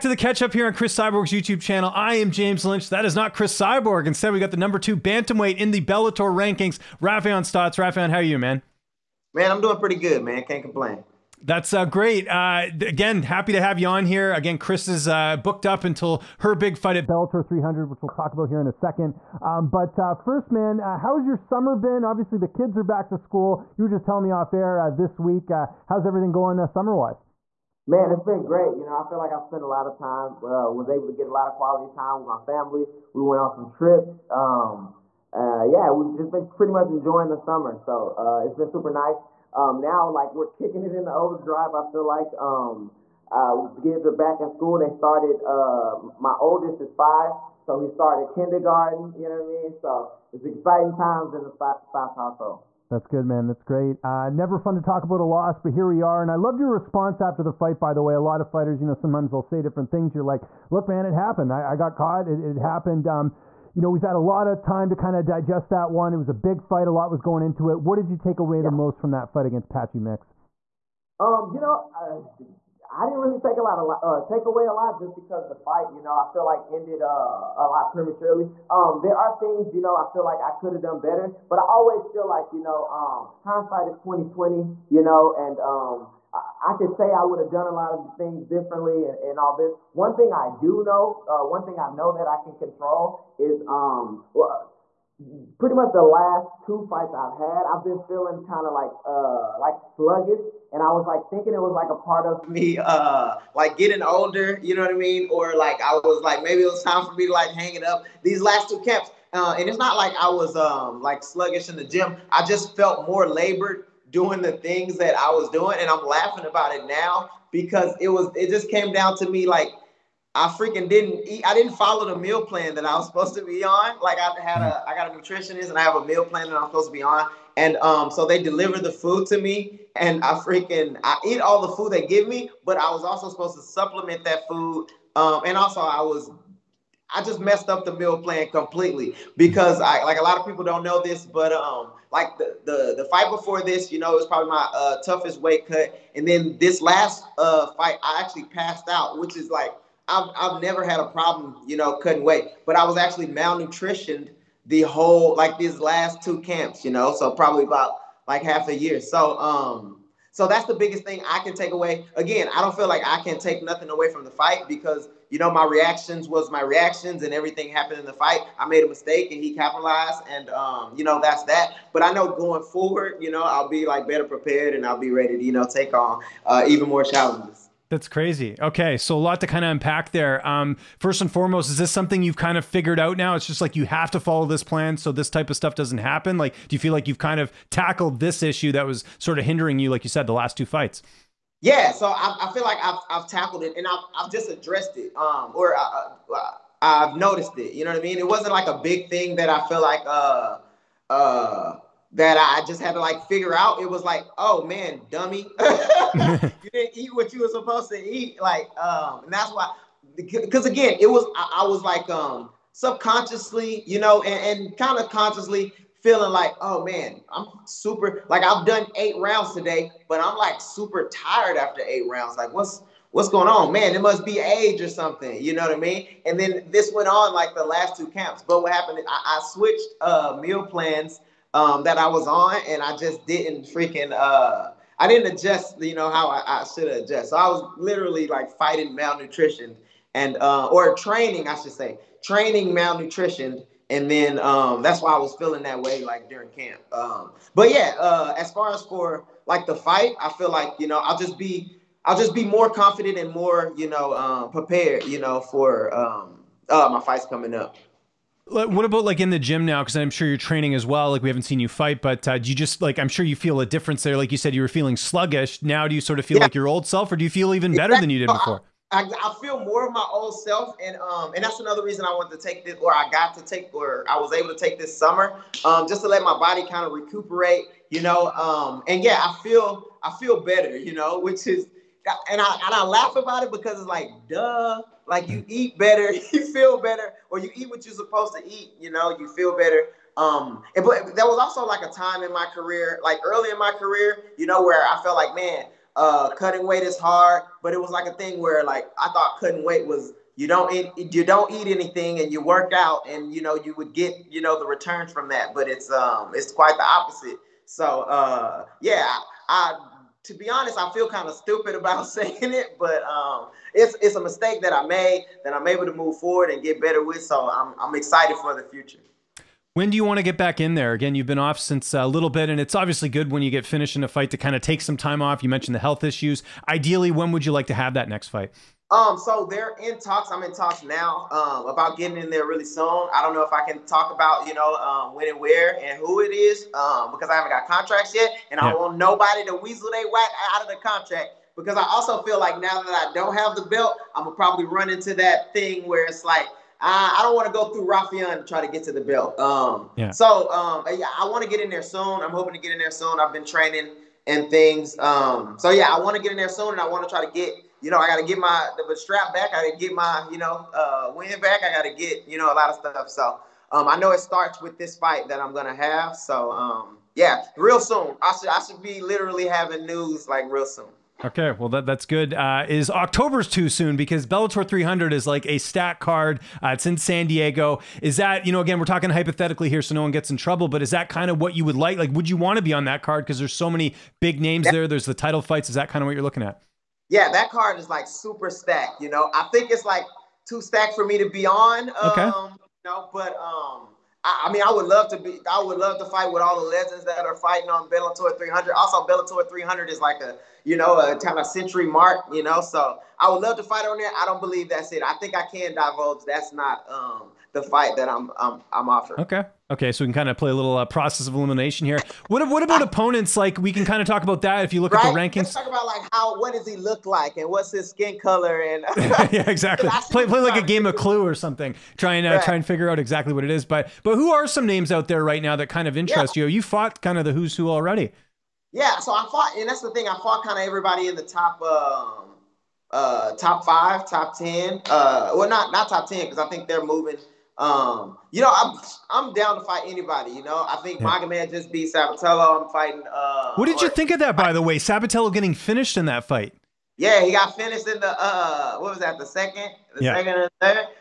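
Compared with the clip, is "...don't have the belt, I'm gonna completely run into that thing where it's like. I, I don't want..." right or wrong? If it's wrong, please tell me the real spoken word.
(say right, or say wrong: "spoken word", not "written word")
wrong: "probably", not "completely".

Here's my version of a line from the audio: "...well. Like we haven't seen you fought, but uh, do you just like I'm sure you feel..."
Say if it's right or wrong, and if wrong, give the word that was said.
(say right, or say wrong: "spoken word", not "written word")
wrong: "fight", not "fought".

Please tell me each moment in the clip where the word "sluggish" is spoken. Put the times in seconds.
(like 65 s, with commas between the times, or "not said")
99 s, 111 s, 264 s.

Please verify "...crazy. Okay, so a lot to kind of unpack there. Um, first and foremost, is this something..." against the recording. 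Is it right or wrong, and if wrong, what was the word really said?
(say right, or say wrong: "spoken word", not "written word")
right.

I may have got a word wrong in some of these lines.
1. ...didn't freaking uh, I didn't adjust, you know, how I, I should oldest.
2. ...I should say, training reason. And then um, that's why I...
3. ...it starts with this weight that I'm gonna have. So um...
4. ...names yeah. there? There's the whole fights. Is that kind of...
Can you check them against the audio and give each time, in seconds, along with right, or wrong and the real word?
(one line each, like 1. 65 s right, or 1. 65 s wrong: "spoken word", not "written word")
1. 233 s wrong: "adjust", not "oldest"
2. 241 s wrong: "malnutrition", not "reason"
3. 364 s wrong: "fight", not "weight"
4. 384 s wrong: "title", not "whole".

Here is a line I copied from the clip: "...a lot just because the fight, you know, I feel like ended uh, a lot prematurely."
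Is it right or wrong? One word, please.
right.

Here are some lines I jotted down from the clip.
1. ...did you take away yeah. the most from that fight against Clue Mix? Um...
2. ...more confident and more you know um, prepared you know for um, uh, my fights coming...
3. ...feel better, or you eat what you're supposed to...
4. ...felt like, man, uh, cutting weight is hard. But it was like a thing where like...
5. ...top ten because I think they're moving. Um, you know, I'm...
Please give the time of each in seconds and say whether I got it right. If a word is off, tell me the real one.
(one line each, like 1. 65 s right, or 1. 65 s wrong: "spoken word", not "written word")
1. 67 s wrong: "Patchy", not "Clue"
2. 252 s right
3. 286 s right
4. 295 s right
5. 435 s right.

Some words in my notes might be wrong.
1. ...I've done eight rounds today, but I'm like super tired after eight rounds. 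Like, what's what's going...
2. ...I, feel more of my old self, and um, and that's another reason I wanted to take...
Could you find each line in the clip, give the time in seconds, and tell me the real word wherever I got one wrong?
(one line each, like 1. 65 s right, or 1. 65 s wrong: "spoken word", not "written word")
1. 218 s right
2. 269 s right.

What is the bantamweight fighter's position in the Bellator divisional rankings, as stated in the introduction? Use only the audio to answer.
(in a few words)
2.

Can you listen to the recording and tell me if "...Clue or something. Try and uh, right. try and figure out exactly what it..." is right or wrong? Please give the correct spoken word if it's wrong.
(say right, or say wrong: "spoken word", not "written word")
right.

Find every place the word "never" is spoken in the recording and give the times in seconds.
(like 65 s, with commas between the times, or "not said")
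54 s, 150 s.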